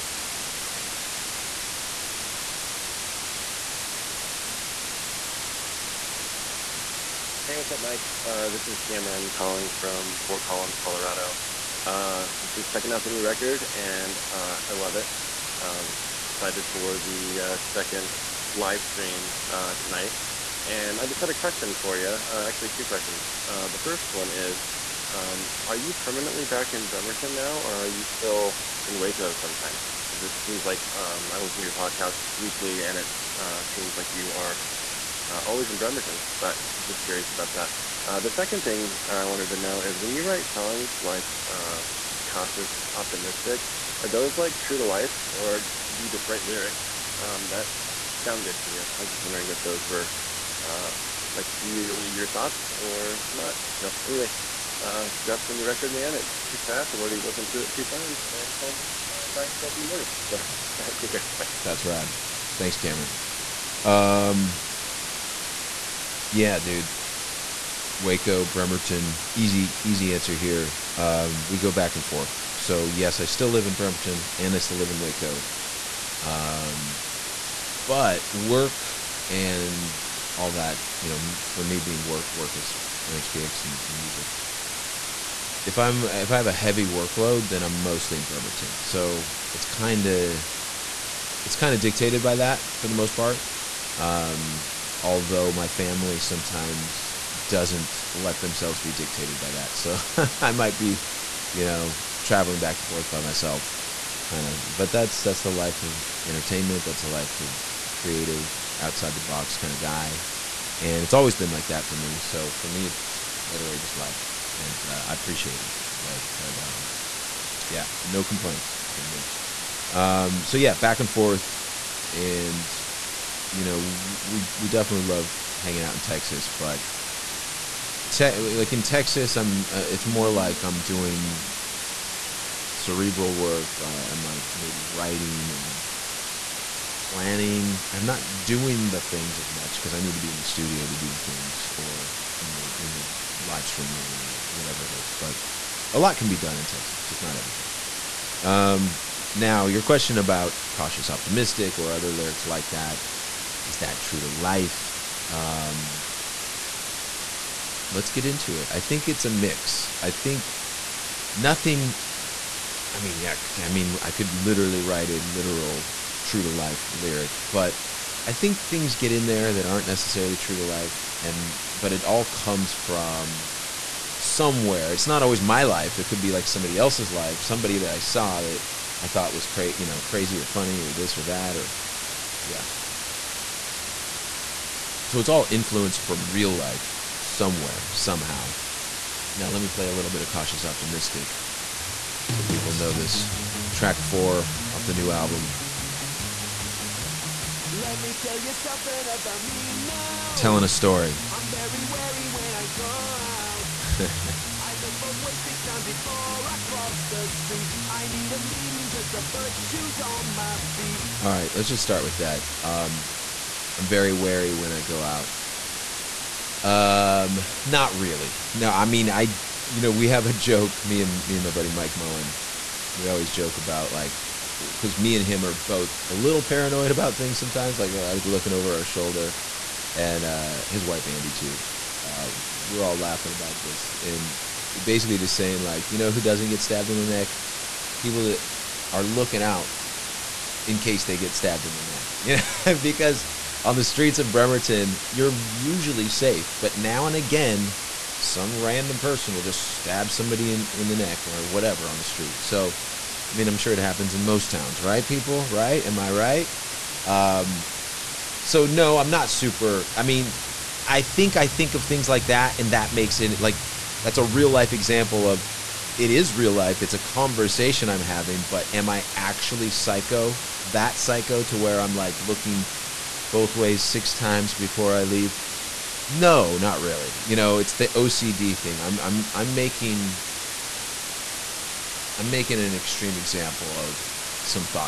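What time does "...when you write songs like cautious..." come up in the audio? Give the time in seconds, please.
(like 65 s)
39 s.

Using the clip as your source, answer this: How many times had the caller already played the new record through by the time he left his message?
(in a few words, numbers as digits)
2.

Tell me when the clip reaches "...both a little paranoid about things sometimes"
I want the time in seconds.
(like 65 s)
225 s.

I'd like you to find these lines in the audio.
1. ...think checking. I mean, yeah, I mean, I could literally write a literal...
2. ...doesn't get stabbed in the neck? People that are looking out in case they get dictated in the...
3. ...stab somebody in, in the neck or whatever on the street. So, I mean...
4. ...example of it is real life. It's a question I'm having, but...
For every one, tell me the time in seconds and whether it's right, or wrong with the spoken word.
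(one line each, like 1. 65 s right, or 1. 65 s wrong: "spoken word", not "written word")
1. 160 s wrong: "nothing", not "checking"
2. 236 s wrong: "stabbed", not "dictated"
3. 249 s right
4. 264 s wrong: "conversation", not "question".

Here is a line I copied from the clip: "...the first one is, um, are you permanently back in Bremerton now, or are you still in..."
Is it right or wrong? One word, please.
right.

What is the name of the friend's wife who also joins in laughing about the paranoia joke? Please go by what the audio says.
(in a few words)
Andy.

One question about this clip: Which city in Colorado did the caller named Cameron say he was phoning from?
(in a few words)
Fort Collins.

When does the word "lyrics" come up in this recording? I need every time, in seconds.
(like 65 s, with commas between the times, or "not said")
46 s, 152 s, 166 s.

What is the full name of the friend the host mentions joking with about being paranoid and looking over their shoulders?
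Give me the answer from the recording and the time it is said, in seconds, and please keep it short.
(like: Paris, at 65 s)
Mike Moen, at 221 s.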